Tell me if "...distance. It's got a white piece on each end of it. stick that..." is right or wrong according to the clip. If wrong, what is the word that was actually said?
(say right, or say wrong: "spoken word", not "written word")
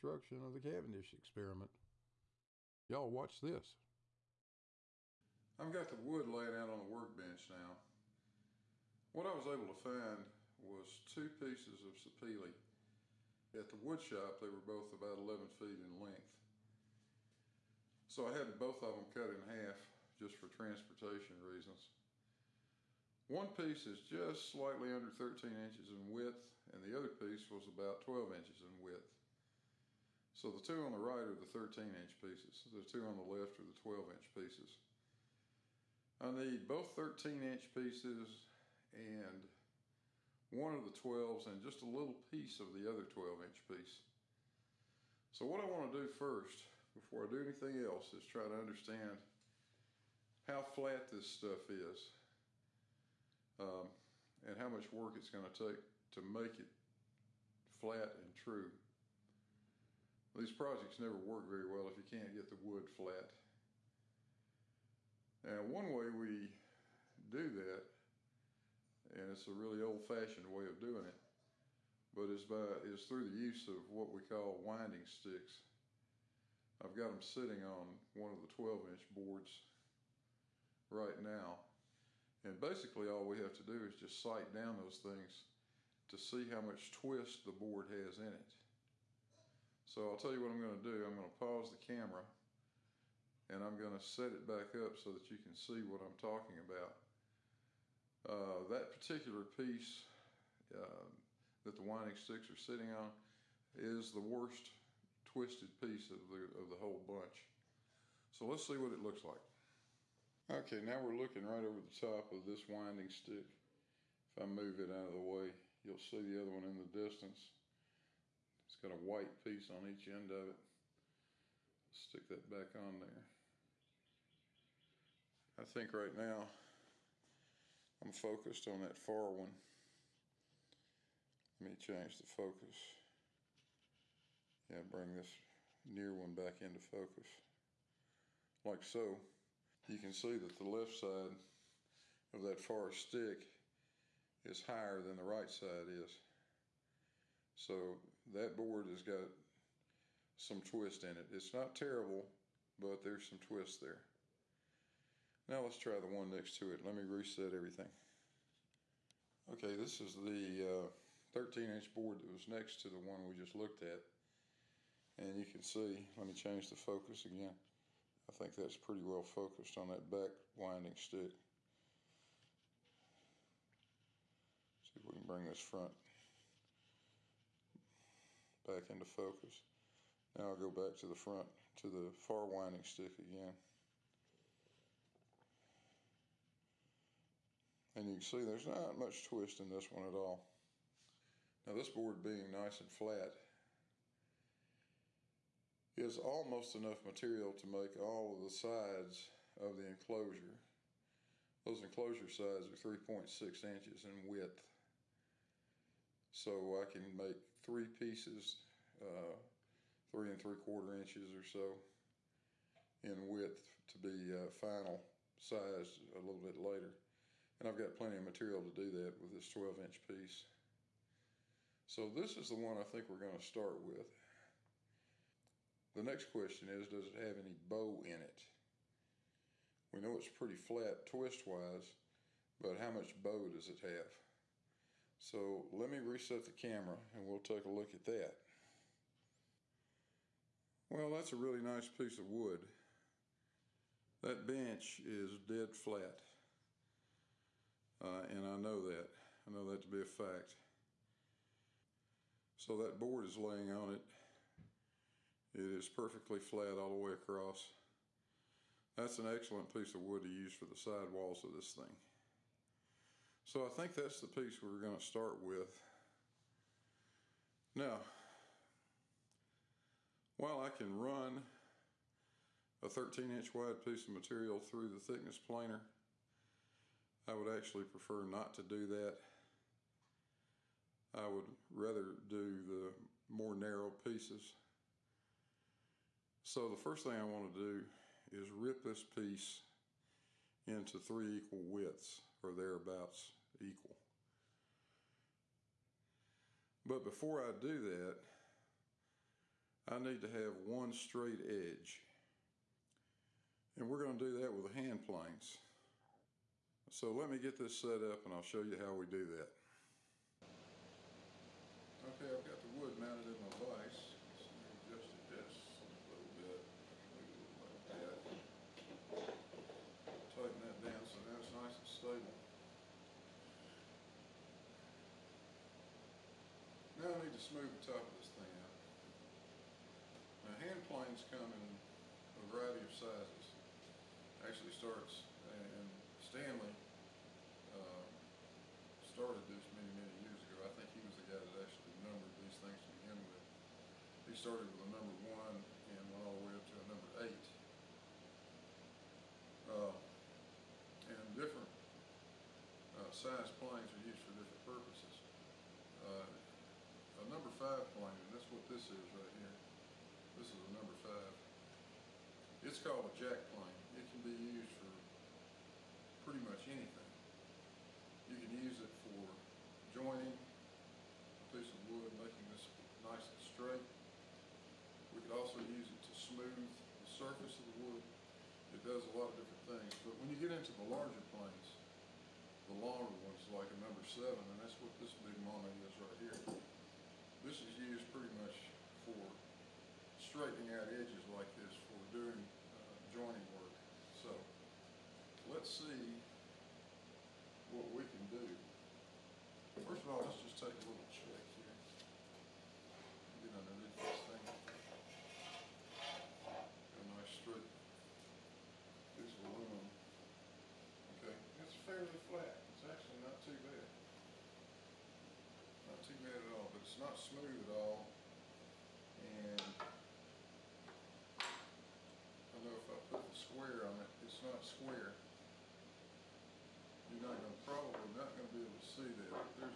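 right.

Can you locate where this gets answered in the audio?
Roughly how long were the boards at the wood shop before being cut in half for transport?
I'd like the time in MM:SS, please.
00:15.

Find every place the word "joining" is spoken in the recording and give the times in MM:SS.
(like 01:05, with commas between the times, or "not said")
06:09, 06:33.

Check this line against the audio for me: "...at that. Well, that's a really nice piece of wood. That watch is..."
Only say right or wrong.
wrong.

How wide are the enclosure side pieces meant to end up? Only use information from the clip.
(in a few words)
3.6 inches.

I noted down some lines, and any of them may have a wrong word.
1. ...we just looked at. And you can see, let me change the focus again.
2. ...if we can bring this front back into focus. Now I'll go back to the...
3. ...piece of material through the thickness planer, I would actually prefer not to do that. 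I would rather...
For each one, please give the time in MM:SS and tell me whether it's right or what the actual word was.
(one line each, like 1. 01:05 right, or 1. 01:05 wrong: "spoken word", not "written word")
1. 02:43 right
2. 02:54 right
3. 04:33 right.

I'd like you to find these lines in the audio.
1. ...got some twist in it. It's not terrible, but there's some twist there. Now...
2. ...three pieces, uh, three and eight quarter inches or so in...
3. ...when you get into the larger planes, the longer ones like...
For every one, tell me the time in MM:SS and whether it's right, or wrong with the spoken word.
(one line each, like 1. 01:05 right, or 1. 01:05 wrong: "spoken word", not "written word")
1. 02:29 right
2. 03:27 wrong: "three", not "eight"
3. 06:20 right.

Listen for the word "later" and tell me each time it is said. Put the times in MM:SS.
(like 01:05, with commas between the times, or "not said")
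03:36.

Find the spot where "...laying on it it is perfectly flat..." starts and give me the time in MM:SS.
04:13.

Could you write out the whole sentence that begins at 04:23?
So I think that's the piece we're going to start with.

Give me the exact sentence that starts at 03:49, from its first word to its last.
We know it's pretty flat twist wise, but how much bow does it have?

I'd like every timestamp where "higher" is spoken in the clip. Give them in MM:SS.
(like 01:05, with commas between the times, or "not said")
02:24.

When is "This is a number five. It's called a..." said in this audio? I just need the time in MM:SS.
06:00.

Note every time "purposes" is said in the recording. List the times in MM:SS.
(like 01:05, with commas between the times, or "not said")
05:54.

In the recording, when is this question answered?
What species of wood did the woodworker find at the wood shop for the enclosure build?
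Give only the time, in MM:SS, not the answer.
00:11.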